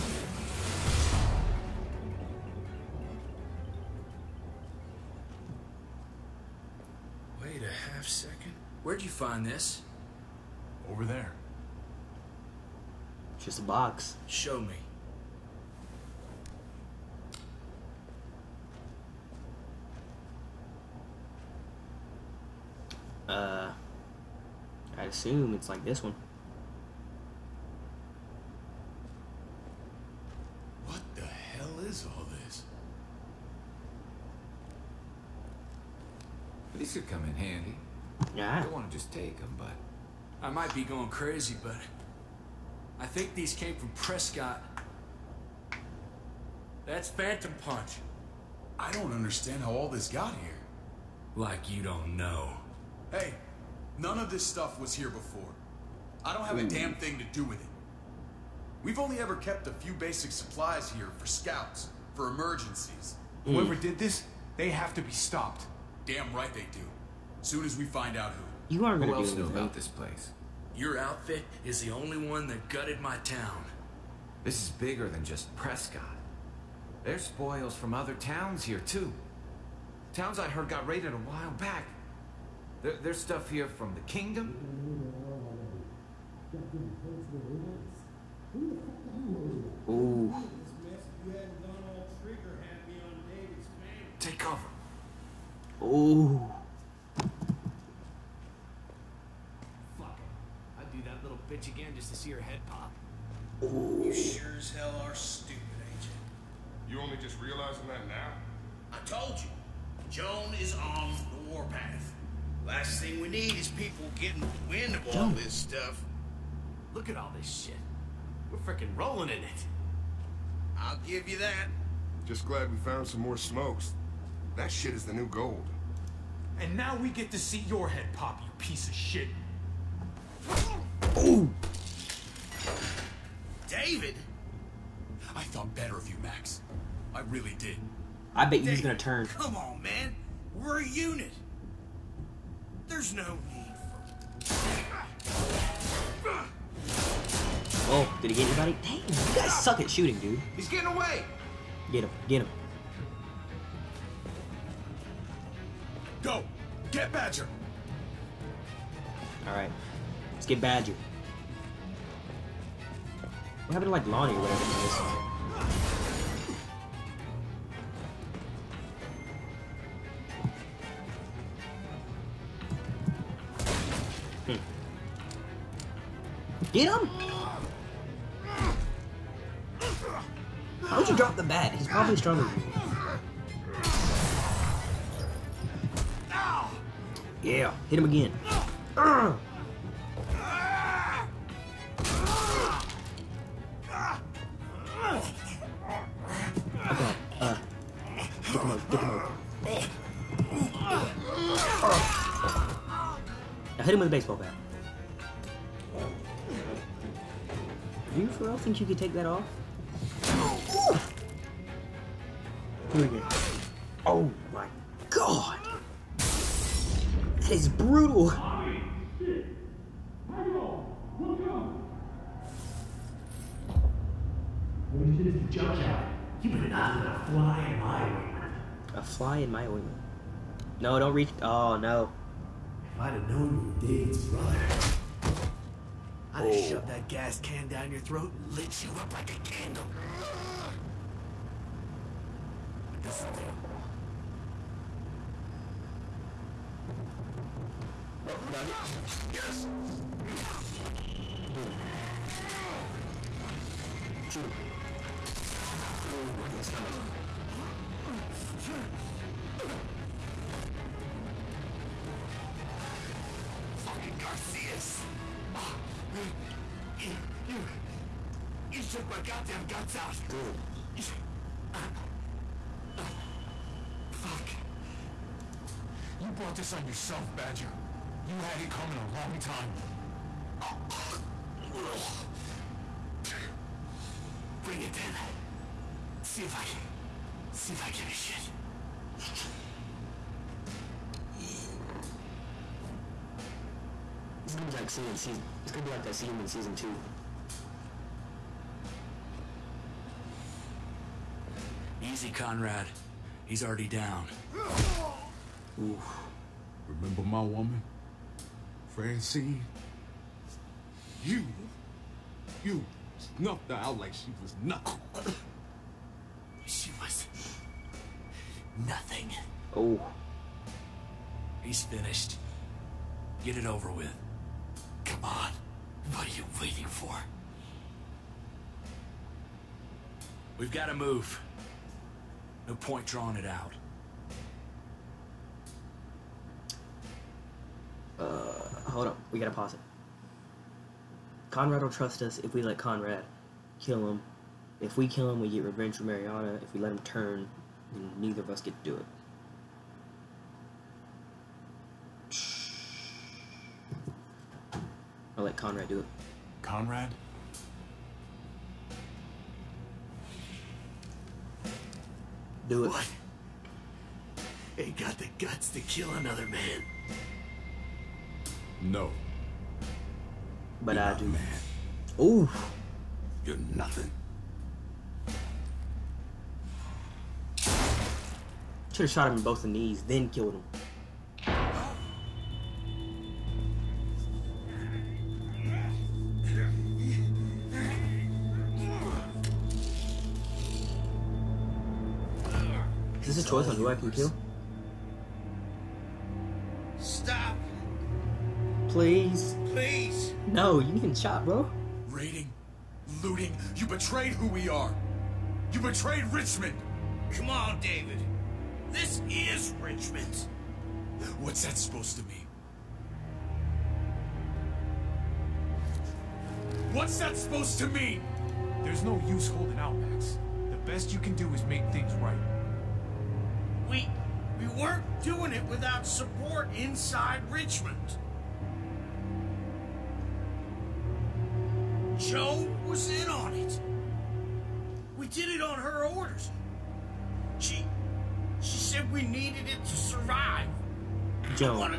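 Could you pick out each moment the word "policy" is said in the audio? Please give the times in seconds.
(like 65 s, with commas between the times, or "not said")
not said.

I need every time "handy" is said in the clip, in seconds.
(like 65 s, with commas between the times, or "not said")
37 s.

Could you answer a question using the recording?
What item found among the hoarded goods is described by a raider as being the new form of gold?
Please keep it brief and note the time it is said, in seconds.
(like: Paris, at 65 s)
Smokes, at 123 s.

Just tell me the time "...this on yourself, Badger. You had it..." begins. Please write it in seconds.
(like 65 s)
276 s.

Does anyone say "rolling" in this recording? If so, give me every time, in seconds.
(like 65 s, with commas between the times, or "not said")
118 s.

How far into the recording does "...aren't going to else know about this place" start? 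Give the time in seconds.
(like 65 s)
68 s.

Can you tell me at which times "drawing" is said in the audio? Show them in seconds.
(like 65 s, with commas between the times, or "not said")
333 s.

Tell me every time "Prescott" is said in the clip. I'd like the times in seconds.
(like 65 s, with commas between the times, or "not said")
43 s, 75 s.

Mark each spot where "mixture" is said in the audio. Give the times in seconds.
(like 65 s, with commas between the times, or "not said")
not said.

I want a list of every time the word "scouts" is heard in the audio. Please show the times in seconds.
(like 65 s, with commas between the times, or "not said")
61 s.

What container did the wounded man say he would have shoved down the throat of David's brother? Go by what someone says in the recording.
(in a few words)
Gas can.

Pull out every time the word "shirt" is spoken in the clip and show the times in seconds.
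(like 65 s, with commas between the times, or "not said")
not said.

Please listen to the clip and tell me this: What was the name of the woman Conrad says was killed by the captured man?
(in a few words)
Francine.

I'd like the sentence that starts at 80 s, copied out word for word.
Towns I heard got raided a while back.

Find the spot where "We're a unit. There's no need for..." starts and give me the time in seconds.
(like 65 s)
140 s.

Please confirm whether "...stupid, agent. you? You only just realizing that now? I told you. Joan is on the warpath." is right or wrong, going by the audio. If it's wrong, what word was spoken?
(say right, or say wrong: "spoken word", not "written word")
right.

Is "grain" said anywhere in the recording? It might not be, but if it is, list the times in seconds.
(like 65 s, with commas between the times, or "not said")
not said.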